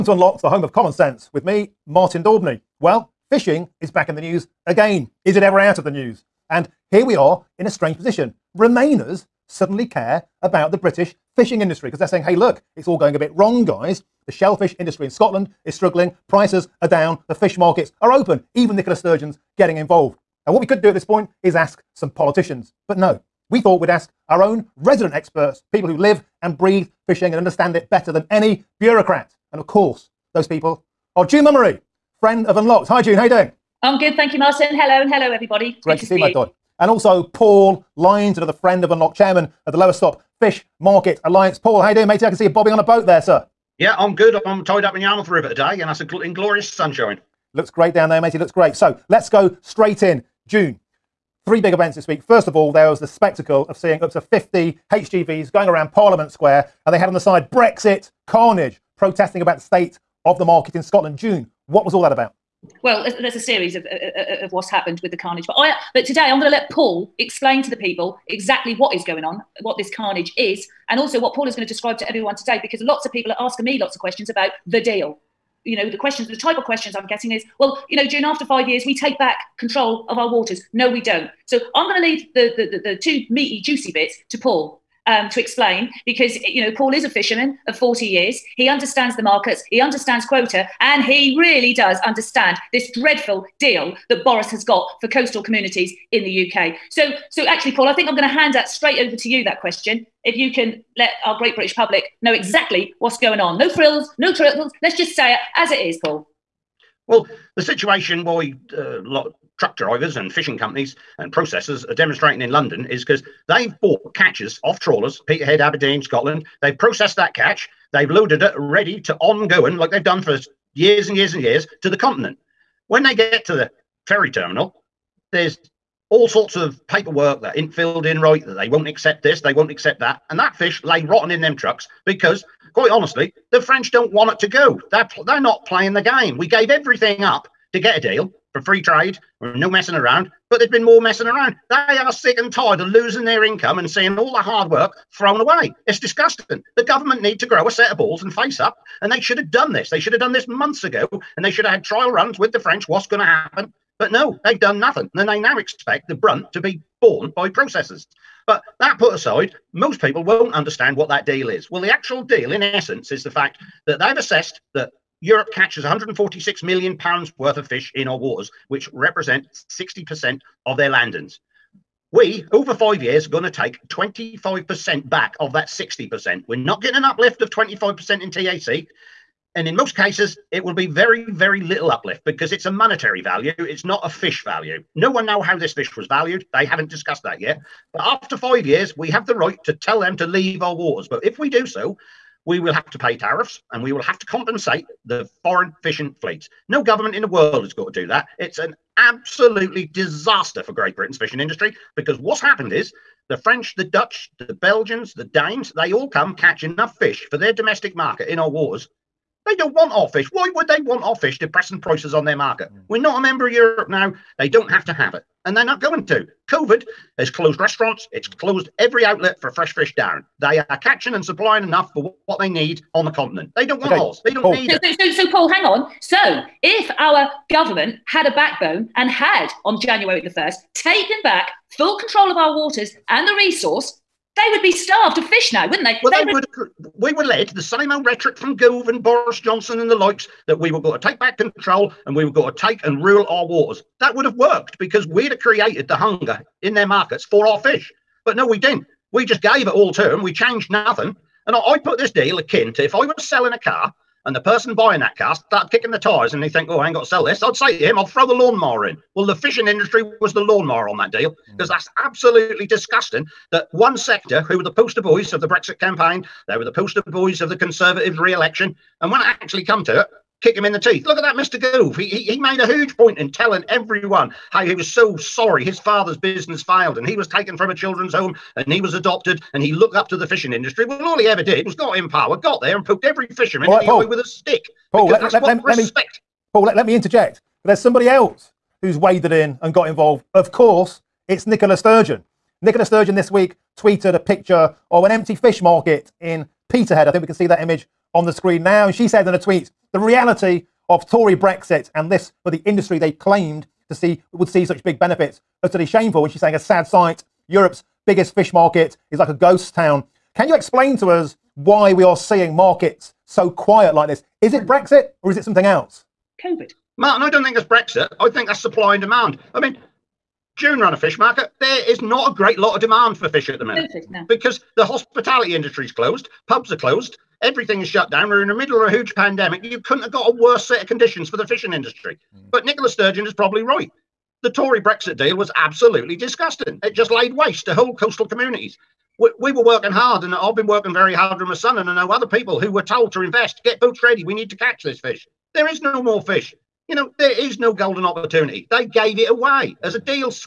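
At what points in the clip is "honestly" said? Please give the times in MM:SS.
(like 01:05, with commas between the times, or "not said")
02:12.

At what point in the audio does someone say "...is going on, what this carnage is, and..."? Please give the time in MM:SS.
01:08.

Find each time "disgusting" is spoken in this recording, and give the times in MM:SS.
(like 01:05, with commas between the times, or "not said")
02:25, 04:22, 05:36.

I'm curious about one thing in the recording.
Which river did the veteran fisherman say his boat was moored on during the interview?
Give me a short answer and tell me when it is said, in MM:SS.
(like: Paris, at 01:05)
Yarmouth River, at 00:44.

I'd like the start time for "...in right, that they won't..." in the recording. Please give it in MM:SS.
02:08.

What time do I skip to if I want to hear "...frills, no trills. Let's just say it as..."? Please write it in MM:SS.
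01:43.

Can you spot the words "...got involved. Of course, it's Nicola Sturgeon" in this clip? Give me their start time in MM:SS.
04:49.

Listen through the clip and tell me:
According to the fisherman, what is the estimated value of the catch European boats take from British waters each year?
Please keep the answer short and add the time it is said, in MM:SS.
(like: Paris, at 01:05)
146 million pounds, at 02:45.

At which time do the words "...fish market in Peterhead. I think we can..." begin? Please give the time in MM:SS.
04:55.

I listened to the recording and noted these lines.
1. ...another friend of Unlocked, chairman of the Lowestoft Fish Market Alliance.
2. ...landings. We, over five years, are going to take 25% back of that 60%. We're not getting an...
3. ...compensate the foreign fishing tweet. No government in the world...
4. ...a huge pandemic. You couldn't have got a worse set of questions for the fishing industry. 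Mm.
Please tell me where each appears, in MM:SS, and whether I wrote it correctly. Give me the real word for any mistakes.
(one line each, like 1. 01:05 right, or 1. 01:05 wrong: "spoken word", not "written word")
1. 00:38 right
2. 02:50 right
3. 03:14 wrong: "fleet", not "tweet"
4. 05:28 wrong: "conditions", not "questions".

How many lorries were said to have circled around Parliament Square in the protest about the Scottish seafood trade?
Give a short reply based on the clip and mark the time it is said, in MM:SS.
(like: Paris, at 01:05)
50, at 00:54.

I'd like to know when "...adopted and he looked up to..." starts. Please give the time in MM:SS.
04:38.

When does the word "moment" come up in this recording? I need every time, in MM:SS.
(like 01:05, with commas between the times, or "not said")
not said.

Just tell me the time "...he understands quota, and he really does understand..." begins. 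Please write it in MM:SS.
01:29.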